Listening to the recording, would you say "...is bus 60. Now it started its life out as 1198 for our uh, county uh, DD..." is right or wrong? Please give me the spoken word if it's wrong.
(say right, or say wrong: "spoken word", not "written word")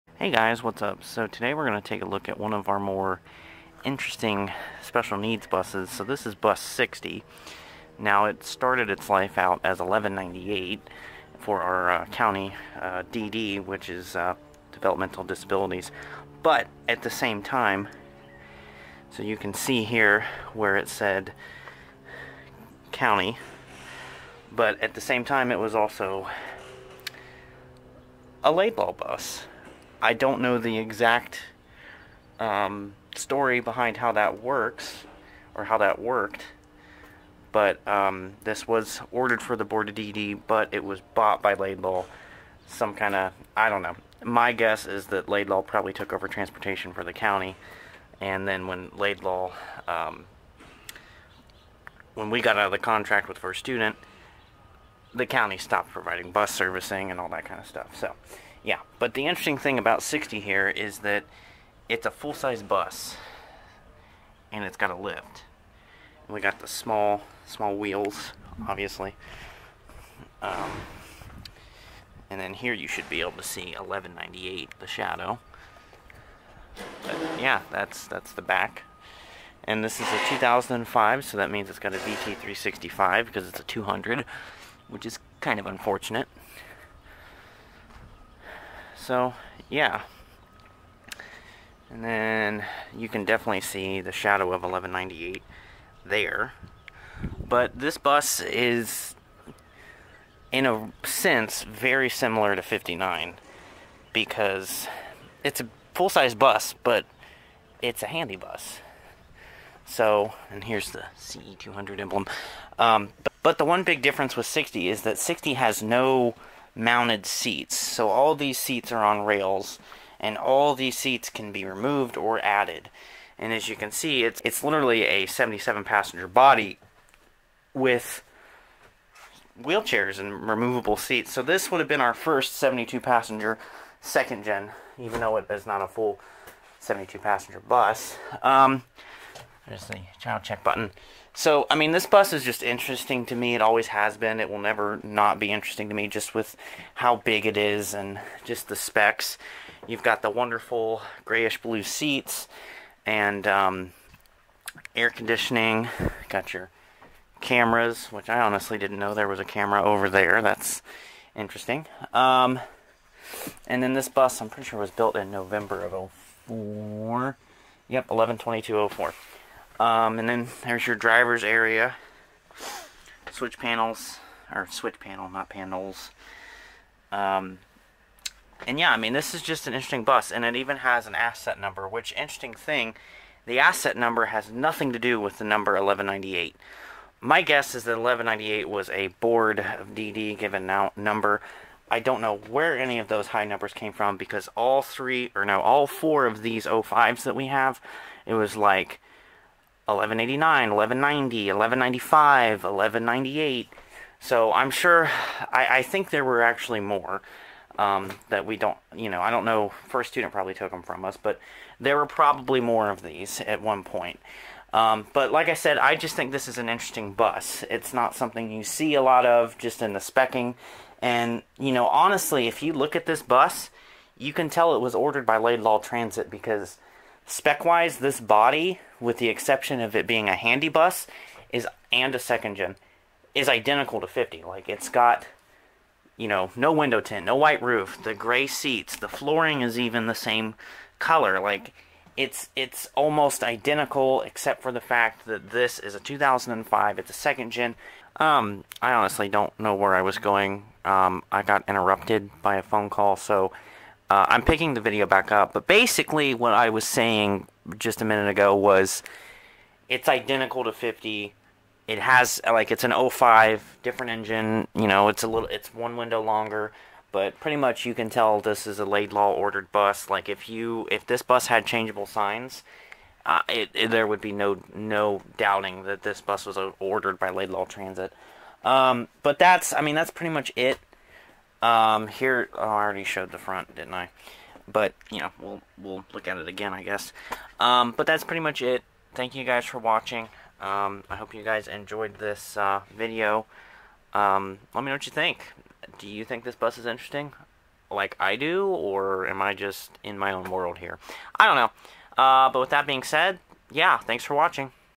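right.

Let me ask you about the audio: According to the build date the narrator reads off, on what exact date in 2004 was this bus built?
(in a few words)
November 22, 2004.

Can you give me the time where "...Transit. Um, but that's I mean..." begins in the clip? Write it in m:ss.
4:37.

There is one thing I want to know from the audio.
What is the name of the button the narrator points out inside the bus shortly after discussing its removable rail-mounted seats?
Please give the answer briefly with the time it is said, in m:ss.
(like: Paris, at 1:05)
child check button, at 2:20.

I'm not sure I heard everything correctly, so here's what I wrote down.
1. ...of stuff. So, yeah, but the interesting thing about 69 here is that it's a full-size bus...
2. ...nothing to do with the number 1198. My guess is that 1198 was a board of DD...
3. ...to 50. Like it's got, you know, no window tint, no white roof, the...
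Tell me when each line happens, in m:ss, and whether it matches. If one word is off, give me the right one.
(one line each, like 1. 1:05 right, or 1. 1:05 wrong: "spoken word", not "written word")
1. 0:57 wrong: "60", not "69"
2. 3:04 right
3. 3:54 right.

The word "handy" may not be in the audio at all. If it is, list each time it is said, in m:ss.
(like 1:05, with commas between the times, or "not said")
1:48, 3:50.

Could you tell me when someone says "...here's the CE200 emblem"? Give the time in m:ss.
1:50.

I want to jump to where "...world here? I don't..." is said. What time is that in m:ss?
5:00.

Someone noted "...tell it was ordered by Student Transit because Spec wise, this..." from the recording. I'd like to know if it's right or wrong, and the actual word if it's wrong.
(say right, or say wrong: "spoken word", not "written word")
wrong: "Laidlaw", not "Student".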